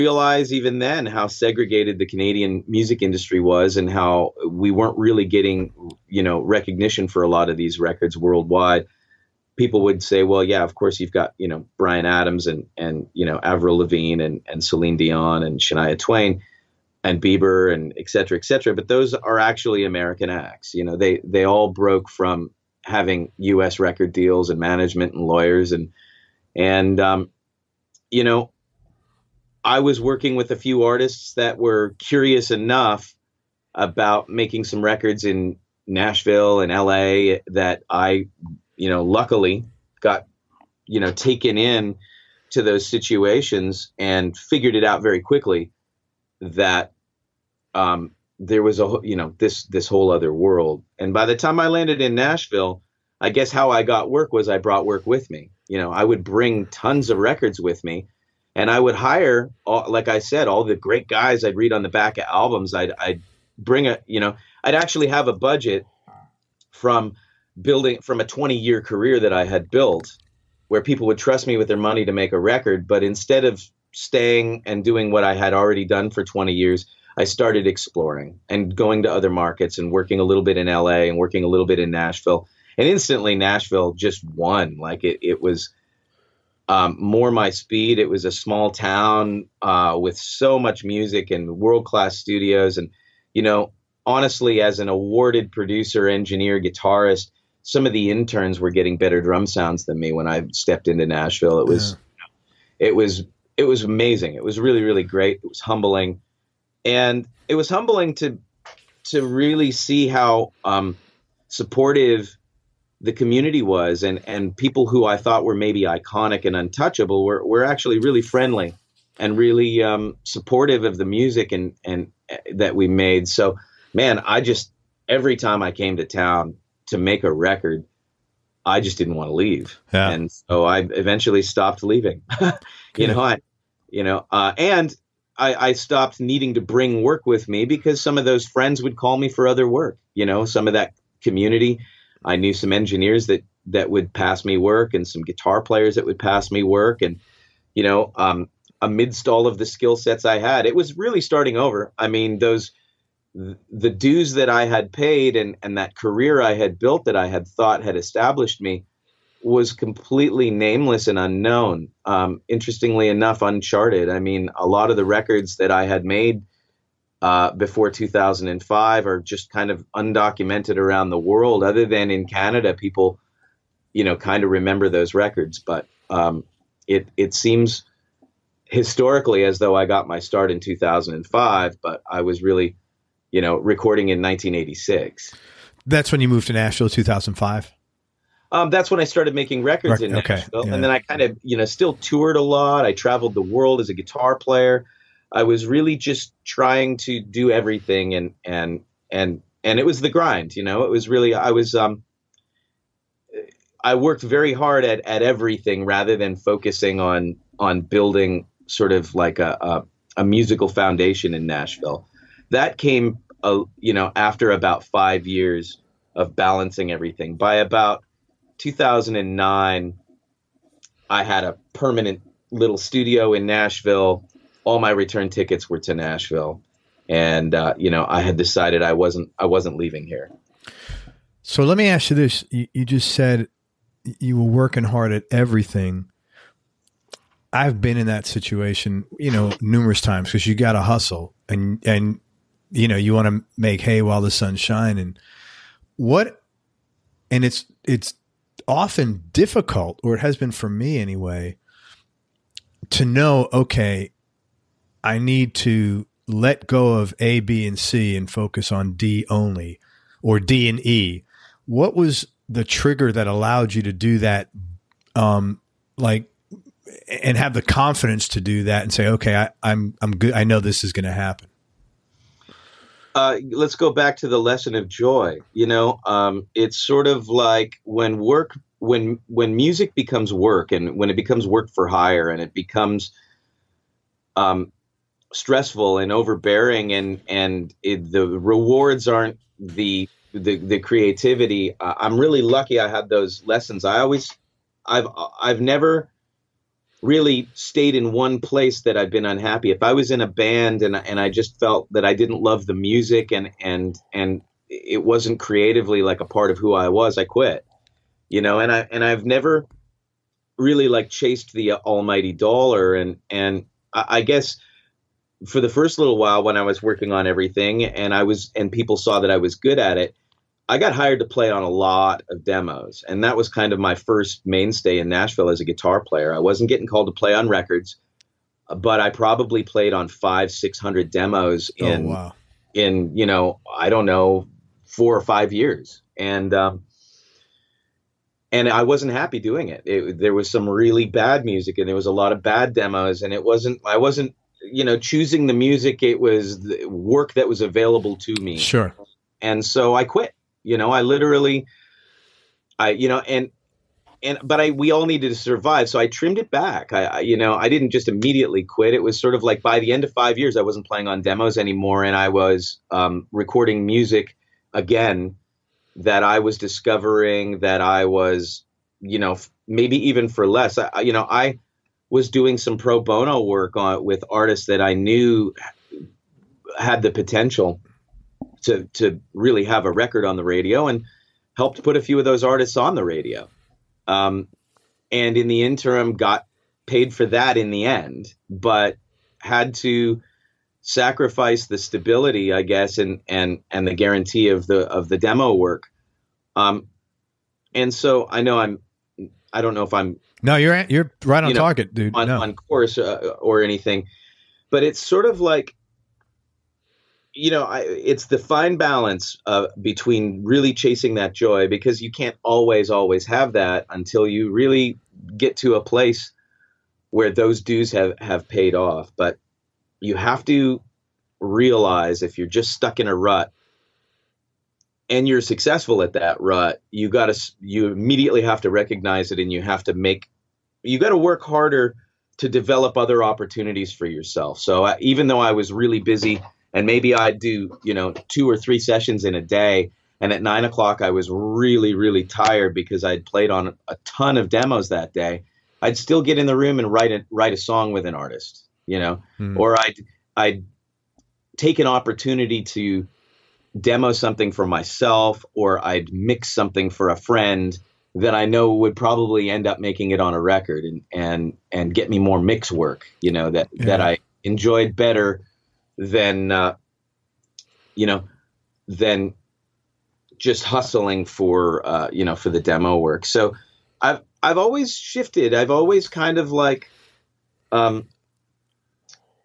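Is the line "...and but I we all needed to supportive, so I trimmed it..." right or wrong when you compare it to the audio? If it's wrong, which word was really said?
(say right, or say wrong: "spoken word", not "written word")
wrong: "survive", not "supportive".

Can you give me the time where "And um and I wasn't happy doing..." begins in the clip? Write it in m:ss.
5:36.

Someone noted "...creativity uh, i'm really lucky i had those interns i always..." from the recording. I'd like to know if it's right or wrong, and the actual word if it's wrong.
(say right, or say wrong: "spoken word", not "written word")
wrong: "lessons", not "interns".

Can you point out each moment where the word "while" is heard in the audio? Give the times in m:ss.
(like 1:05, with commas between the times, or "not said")
4:04, 5:16.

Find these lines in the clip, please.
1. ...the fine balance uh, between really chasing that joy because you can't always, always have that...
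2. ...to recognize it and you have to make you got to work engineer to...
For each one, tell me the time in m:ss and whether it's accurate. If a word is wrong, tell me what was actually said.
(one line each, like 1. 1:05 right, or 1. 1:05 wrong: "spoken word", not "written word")
1. 6:48 right
2. 7:08 wrong: "harder", not "engineer".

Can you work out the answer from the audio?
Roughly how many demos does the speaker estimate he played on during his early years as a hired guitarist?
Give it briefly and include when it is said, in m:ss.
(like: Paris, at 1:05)
500-600, at 5:30.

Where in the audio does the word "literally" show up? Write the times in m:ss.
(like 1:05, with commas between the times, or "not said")
5:51.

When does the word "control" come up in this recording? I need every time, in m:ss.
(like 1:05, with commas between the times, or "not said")
not said.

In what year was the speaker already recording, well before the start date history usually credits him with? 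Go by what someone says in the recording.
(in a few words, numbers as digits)
1986.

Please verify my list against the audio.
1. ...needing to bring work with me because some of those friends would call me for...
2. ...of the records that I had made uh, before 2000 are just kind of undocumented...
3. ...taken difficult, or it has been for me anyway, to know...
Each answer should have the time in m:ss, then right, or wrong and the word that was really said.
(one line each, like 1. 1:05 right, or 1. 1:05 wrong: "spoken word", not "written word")
1. 2:16 right
2. 2:44 wrong: "2005", not "2000"
3. 4:08 wrong: "often", not "taken".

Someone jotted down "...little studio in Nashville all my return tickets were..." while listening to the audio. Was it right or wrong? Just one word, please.
right.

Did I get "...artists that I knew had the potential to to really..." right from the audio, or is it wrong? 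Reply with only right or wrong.
right.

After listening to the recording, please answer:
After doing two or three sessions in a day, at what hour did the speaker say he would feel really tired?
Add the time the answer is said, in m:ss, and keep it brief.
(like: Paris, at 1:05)
9:00, at 7:20.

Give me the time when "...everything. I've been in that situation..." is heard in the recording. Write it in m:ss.
3:55.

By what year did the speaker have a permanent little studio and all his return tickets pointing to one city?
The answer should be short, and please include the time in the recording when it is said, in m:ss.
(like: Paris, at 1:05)
2009, at 3:38.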